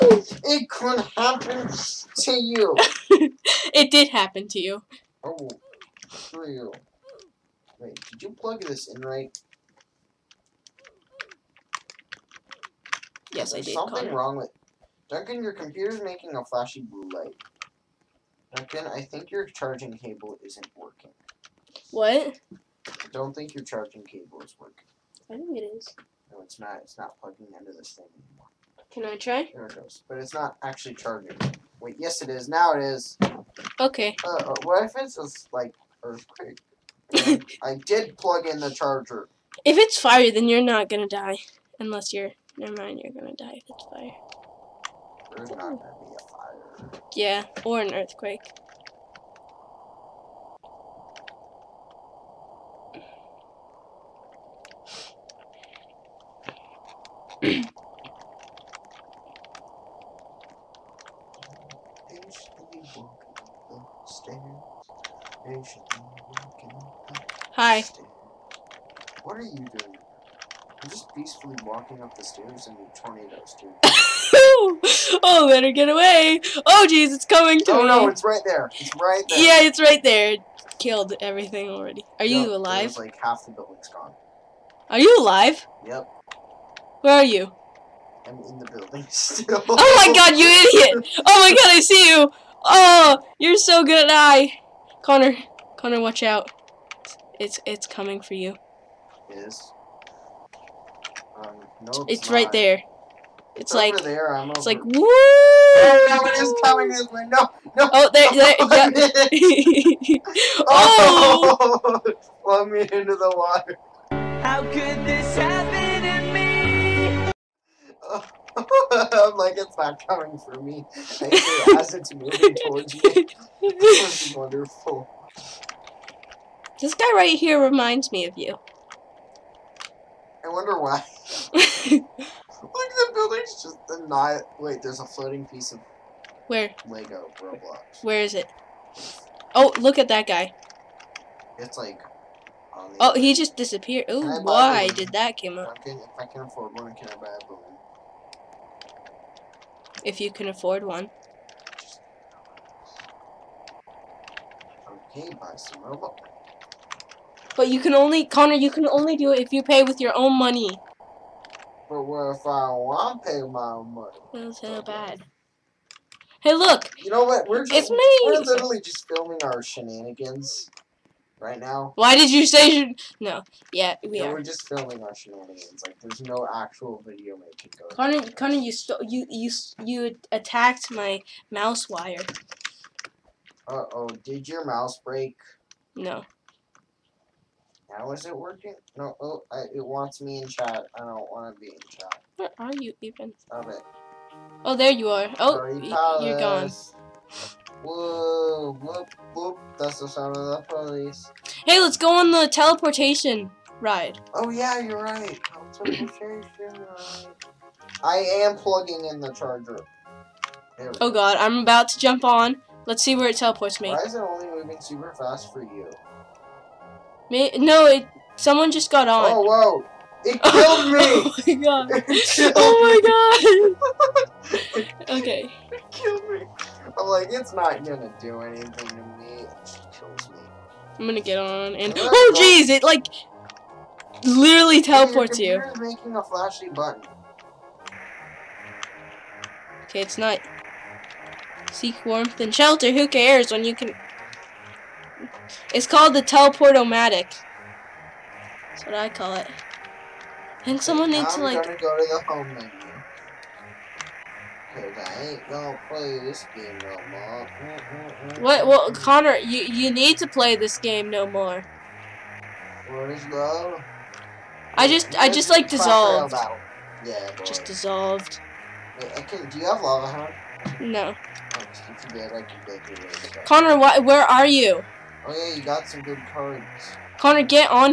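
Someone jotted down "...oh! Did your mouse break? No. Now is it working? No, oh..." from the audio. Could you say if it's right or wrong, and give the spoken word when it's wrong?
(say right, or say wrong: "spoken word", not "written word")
right.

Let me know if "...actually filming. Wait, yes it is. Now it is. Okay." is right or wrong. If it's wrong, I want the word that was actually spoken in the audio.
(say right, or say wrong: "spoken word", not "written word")
wrong: "charging", not "filming".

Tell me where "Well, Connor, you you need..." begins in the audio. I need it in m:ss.
4:18.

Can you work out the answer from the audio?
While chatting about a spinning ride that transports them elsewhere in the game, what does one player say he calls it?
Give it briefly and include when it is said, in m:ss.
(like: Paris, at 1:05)
teleportomatic, at 4:06.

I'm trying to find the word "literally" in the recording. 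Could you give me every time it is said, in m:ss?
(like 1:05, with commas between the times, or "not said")
2:48, 3:54.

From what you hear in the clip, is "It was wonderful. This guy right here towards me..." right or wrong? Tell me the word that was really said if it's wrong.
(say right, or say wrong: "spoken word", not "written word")
wrong: "reminds", not "towards".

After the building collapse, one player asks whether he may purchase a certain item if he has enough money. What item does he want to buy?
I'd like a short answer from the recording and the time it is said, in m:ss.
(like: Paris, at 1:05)
a balloon, at 2:27.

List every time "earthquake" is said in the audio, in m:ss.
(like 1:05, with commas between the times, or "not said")
0:36, 0:47.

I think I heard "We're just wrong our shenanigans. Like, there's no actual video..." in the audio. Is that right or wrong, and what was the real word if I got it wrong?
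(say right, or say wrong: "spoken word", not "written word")
wrong: "filming", not "wrong".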